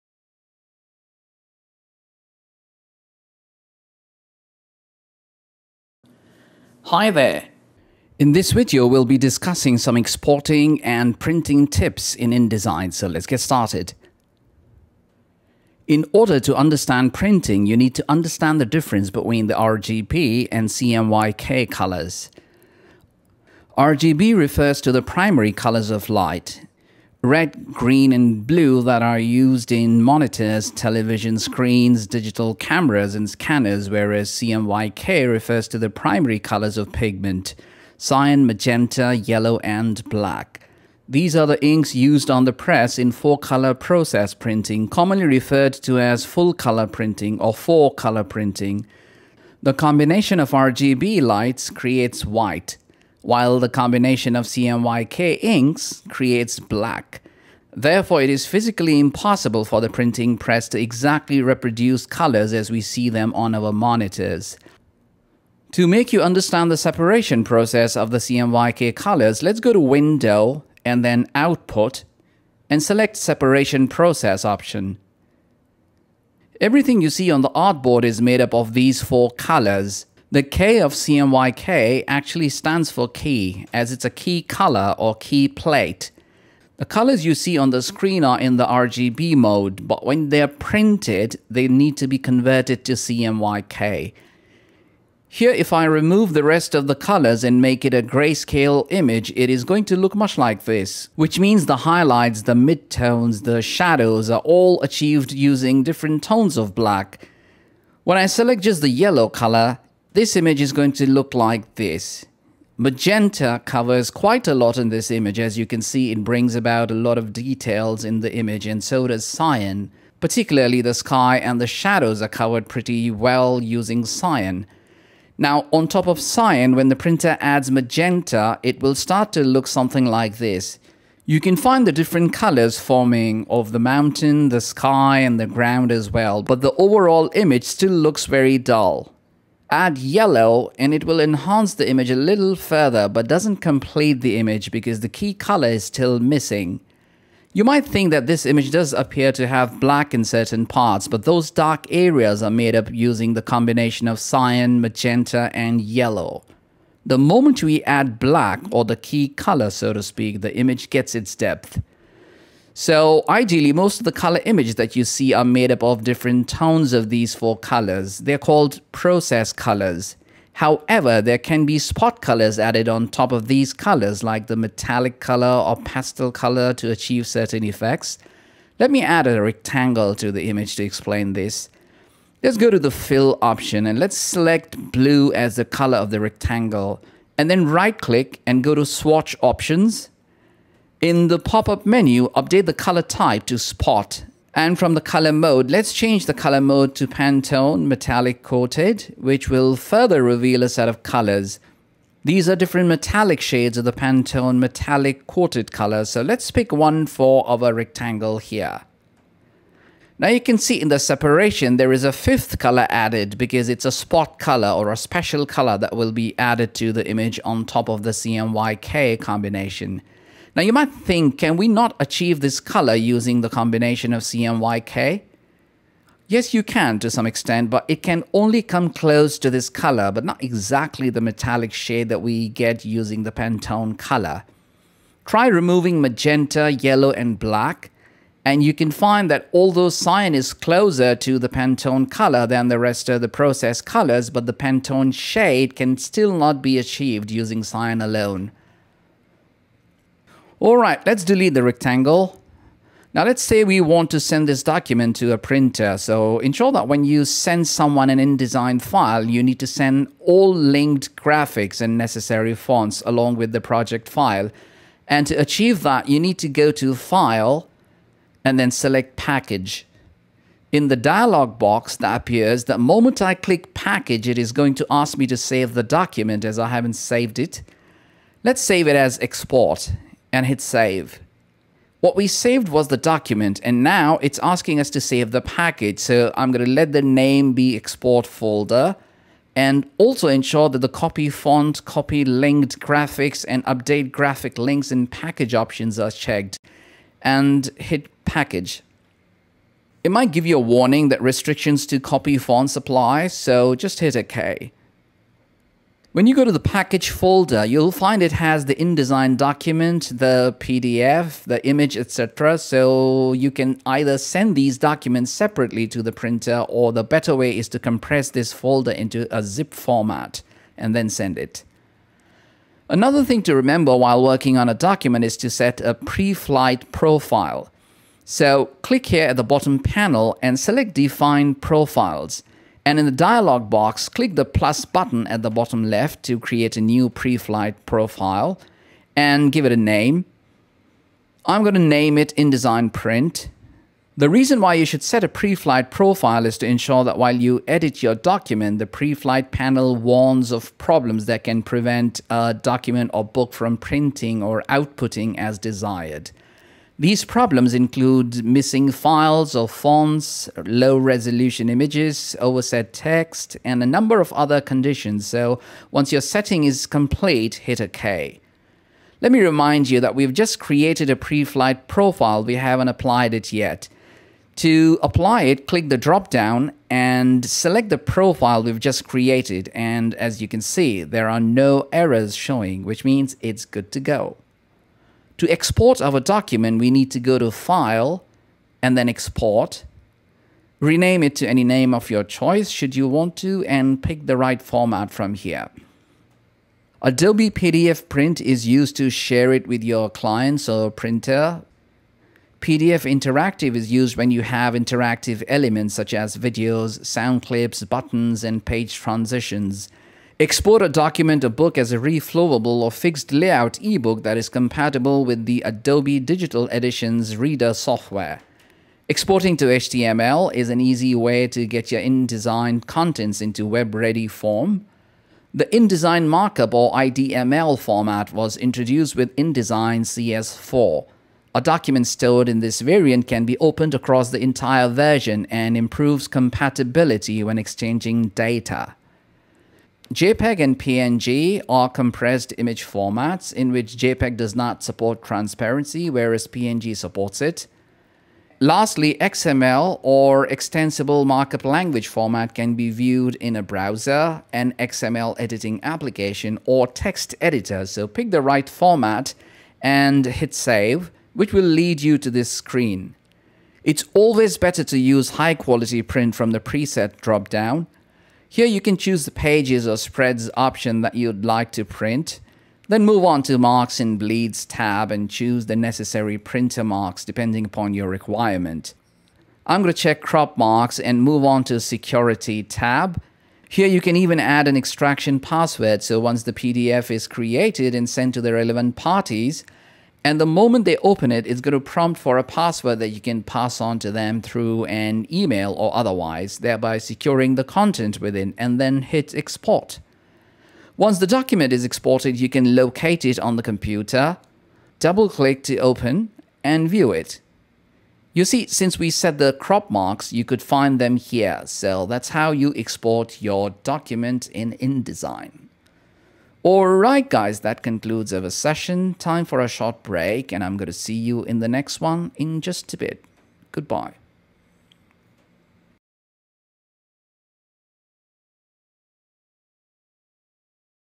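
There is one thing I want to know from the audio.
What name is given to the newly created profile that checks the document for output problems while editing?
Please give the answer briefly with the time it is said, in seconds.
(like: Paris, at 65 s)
InDesign Print, at 342 s.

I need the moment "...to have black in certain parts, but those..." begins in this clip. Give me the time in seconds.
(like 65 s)
149 s.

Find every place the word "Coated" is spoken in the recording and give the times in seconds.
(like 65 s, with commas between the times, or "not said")
198 s, 205 s.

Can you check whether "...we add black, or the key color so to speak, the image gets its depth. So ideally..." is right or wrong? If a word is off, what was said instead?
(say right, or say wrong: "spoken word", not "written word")
right.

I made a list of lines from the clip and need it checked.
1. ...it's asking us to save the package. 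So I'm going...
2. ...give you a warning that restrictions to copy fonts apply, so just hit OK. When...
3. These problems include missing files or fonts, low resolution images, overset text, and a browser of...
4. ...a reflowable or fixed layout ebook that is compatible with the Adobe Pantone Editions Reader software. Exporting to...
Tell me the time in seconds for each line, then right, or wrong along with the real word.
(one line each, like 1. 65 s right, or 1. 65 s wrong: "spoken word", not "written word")
1. 284 s right
2. 300 s right
3. 357 s wrong: "number", not "browser"
4. 411 s wrong: "Digital", not "Pantone".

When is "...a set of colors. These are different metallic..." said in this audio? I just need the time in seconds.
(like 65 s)
200 s.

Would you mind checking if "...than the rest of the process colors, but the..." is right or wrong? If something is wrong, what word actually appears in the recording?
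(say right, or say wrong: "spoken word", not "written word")
right.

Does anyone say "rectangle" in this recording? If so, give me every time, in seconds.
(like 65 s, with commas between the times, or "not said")
179 s, 186 s, 207 s, 251 s.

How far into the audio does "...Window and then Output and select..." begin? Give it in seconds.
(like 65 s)
69 s.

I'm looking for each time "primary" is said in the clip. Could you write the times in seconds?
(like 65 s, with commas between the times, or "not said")
25 s, 35 s.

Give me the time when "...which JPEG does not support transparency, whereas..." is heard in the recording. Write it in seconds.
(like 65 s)
443 s.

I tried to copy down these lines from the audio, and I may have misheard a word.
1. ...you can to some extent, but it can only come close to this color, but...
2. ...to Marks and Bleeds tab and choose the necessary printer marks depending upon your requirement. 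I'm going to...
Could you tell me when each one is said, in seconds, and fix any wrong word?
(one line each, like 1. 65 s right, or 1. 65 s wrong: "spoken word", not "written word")
1. 226 s right
2. 473 s right.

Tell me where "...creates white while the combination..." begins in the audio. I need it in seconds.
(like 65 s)
51 s.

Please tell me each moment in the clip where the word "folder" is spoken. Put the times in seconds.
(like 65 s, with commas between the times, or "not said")
288 s, 307 s, 318 s.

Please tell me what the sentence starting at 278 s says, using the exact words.
Let's save it as Export and hit save.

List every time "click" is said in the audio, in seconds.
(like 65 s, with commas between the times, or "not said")
188 s, 273 s, 328 s, 334 s, 375 s, 505 s.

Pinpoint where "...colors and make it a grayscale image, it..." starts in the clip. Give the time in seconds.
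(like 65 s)
96 s.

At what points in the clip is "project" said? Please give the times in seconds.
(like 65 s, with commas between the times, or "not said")
263 s.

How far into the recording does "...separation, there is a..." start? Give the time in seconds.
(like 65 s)
210 s.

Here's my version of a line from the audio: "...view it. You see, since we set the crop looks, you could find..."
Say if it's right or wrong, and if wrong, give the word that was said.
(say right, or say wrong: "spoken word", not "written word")
wrong: "marks", not "looks".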